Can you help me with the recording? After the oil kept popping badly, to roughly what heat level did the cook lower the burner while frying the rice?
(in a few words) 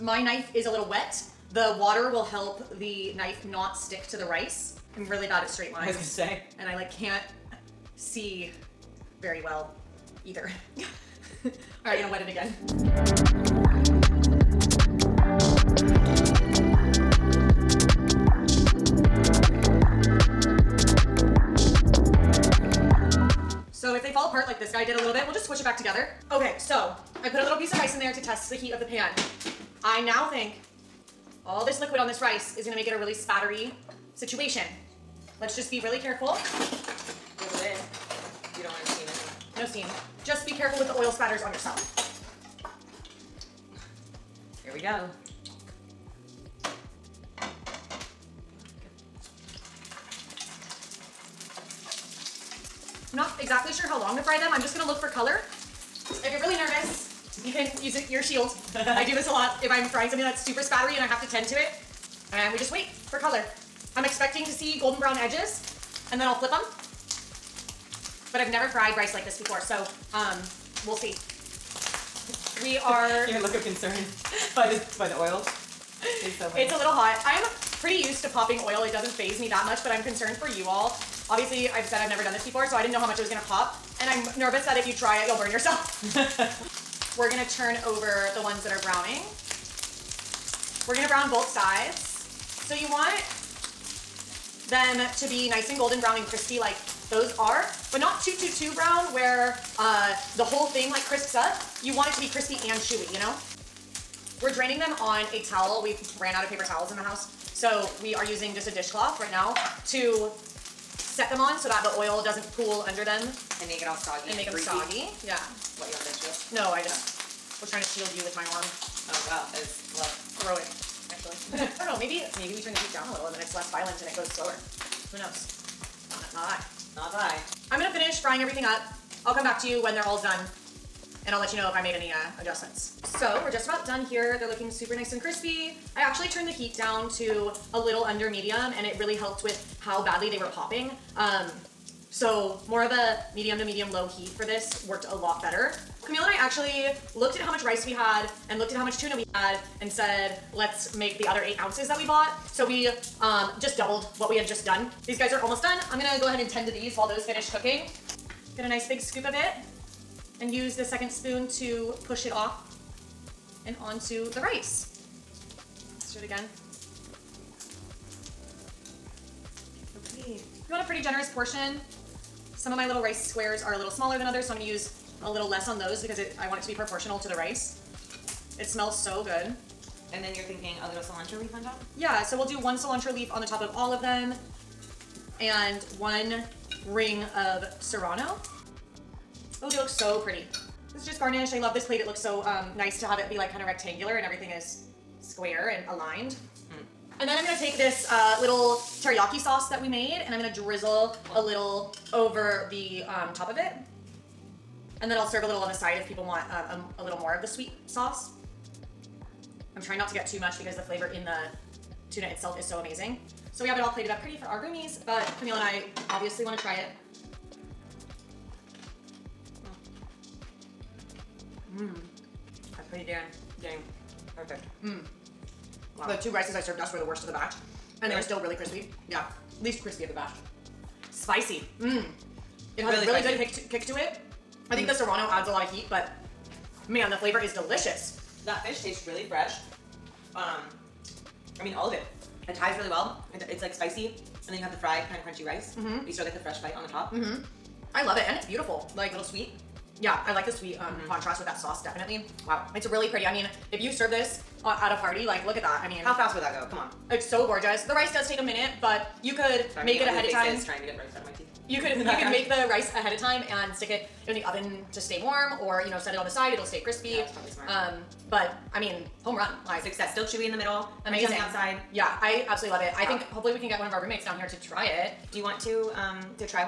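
A little under medium.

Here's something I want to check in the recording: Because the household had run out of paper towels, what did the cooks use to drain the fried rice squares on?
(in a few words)
A dishcloth.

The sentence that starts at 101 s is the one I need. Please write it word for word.
You want it to be crispy and chewy, you know?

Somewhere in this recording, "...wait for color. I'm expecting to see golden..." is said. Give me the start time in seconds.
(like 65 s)
62 s.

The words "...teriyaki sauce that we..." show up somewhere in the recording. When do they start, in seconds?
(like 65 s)
199 s.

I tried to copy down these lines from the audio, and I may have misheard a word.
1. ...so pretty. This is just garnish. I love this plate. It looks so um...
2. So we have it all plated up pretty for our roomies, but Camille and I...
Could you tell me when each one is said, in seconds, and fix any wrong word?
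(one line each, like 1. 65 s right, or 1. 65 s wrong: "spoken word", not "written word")
1. 189 s right
2. 213 s right.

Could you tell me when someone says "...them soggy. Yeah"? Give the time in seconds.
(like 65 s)
114 s.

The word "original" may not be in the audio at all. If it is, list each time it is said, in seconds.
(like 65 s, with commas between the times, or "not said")
not said.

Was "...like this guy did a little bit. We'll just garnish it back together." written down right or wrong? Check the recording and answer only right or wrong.
wrong.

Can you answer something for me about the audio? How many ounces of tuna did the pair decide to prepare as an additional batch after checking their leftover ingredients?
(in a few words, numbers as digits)
8.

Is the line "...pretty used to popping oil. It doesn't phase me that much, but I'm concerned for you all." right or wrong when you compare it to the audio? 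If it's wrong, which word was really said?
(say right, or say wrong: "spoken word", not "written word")
right.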